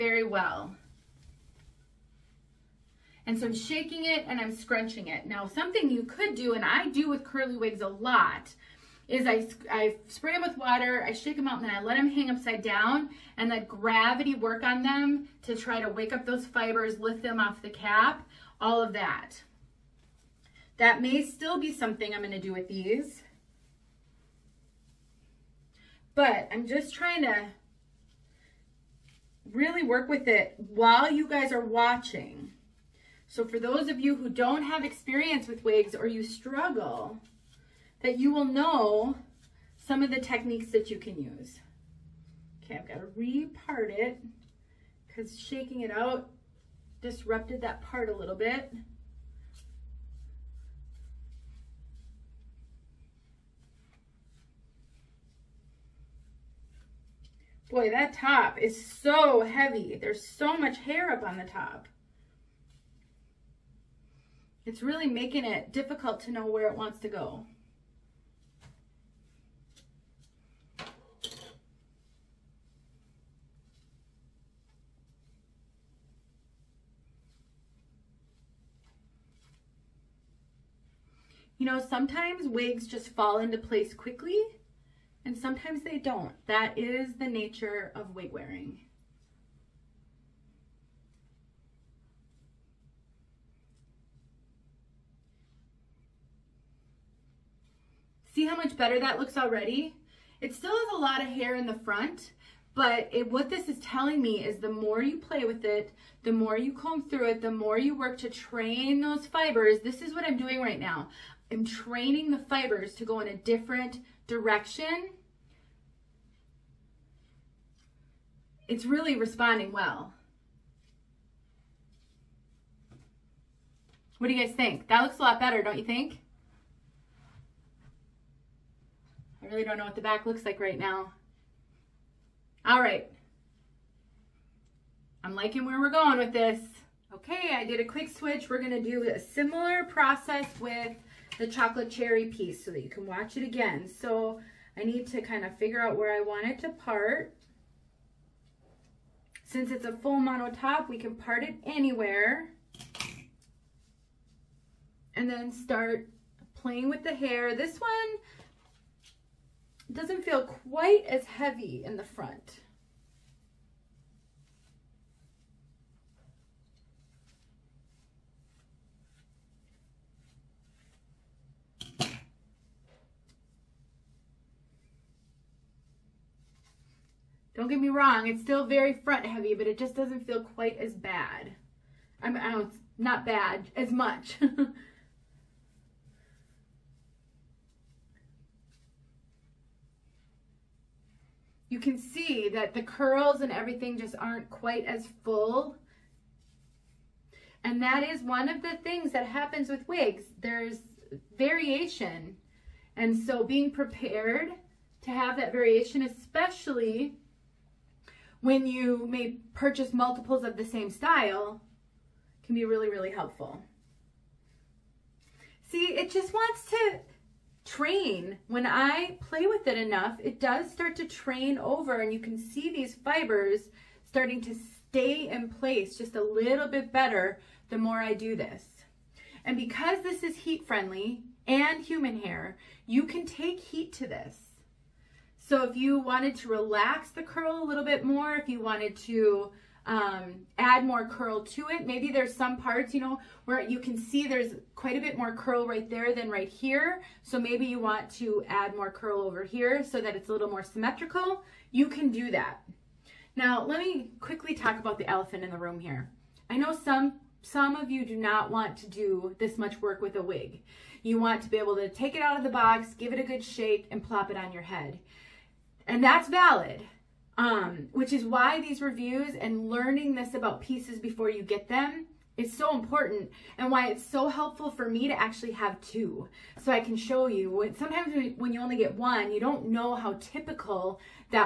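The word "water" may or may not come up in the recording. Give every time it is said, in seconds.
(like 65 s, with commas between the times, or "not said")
10 s.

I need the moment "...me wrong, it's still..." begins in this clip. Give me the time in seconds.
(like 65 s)
177 s.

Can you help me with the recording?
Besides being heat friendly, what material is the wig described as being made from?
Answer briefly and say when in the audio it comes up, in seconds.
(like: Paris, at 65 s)
Human hair, at 231 s.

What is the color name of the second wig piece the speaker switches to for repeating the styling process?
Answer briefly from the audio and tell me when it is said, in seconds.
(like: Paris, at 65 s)
Chocolate cherry, at 141 s.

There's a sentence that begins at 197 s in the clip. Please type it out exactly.
And that is one of the things that happens with wigs.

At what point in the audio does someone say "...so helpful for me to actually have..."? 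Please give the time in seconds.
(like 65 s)
274 s.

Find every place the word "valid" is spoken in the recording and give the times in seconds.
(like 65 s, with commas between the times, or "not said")
266 s.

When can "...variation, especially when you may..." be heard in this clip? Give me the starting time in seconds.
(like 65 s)
205 s.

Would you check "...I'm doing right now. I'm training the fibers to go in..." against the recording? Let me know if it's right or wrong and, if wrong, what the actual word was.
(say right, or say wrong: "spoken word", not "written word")
right.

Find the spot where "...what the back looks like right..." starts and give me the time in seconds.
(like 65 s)
129 s.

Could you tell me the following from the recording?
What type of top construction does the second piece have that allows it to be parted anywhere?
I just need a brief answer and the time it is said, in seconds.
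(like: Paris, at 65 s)
Full mono top, at 149 s.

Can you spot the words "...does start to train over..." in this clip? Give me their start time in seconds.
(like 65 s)
220 s.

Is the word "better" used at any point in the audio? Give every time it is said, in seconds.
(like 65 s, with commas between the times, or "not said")
98 s, 125 s, 226 s.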